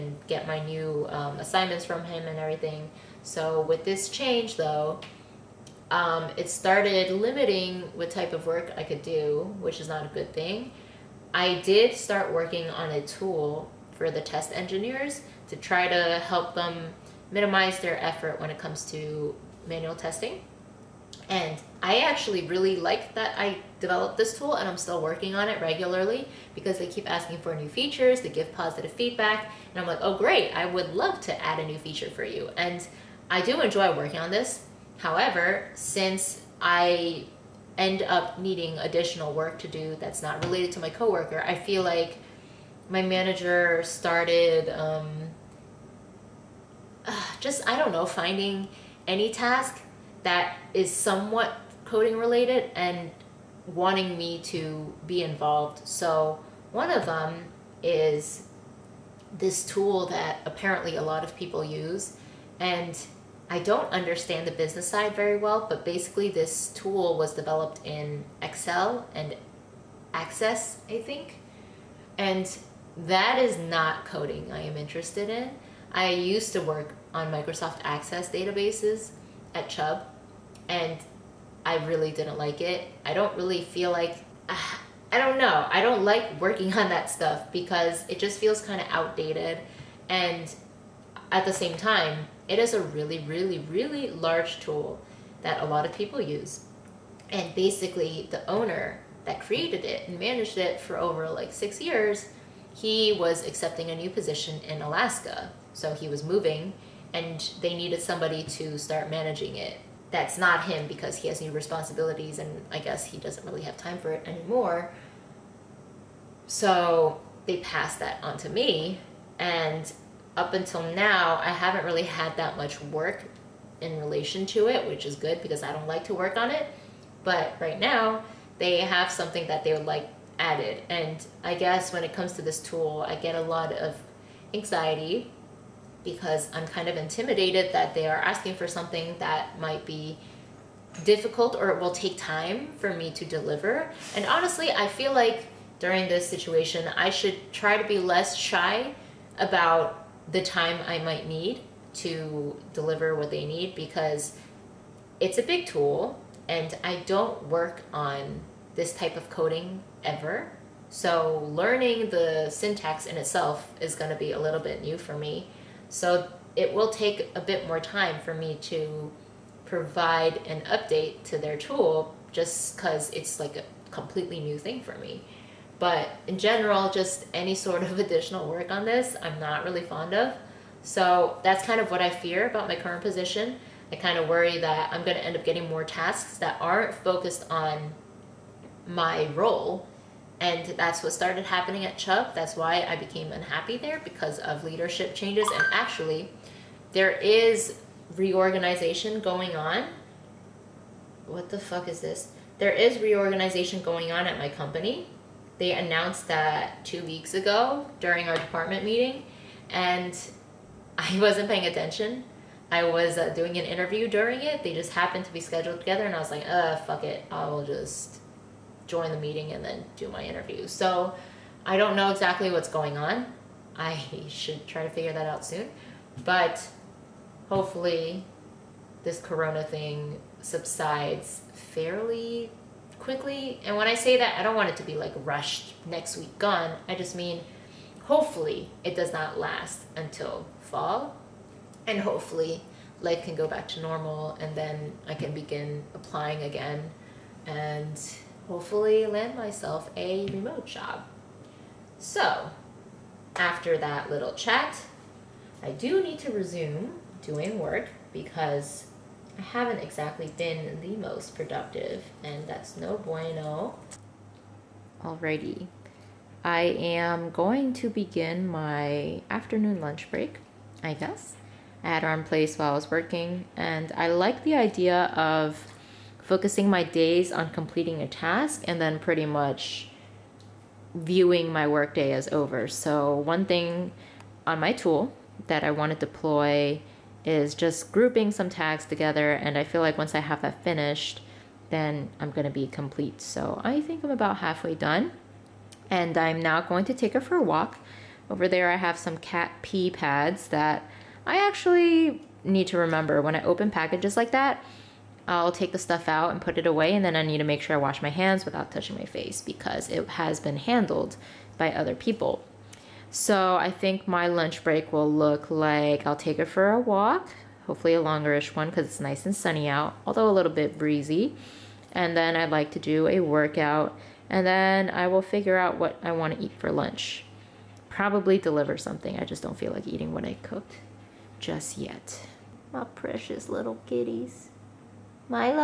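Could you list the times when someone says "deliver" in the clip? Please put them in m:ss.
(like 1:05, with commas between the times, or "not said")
2:23, 2:32, 5:28.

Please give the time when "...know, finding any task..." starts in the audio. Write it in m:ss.
0:47.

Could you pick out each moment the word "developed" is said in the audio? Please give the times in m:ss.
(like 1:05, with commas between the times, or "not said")
0:23, 1:07.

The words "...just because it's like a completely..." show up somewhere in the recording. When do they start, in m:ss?
2:52.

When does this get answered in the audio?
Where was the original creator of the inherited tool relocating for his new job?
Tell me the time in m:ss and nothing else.
1:44.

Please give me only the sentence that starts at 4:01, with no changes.
And hopefully life can go back to normal and then I can begin applying again and hopefully land myself a remote job.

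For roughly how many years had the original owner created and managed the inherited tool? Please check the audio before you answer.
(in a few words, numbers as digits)
6.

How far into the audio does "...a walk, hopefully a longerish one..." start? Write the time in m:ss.
5:16.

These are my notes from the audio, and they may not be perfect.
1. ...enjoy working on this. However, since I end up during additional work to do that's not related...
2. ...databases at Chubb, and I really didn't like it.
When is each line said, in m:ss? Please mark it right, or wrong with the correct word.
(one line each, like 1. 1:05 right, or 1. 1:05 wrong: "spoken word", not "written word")
1. 0:33 wrong: "needing", not "during"
2. 1:18 right.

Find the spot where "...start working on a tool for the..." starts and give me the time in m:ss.
0:11.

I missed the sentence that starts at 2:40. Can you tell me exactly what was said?
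So learning the syntax in itself is going to be a little bit new for me.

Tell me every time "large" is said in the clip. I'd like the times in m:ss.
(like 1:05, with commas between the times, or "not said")
1:34.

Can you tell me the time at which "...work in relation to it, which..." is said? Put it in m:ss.
2:02.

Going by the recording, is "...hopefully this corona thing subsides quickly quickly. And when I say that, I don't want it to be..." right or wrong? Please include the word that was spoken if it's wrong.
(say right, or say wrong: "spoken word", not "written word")
wrong: "fairly", not "quickly".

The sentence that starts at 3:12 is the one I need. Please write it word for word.
That's why I became unhappy there because of leadership changes.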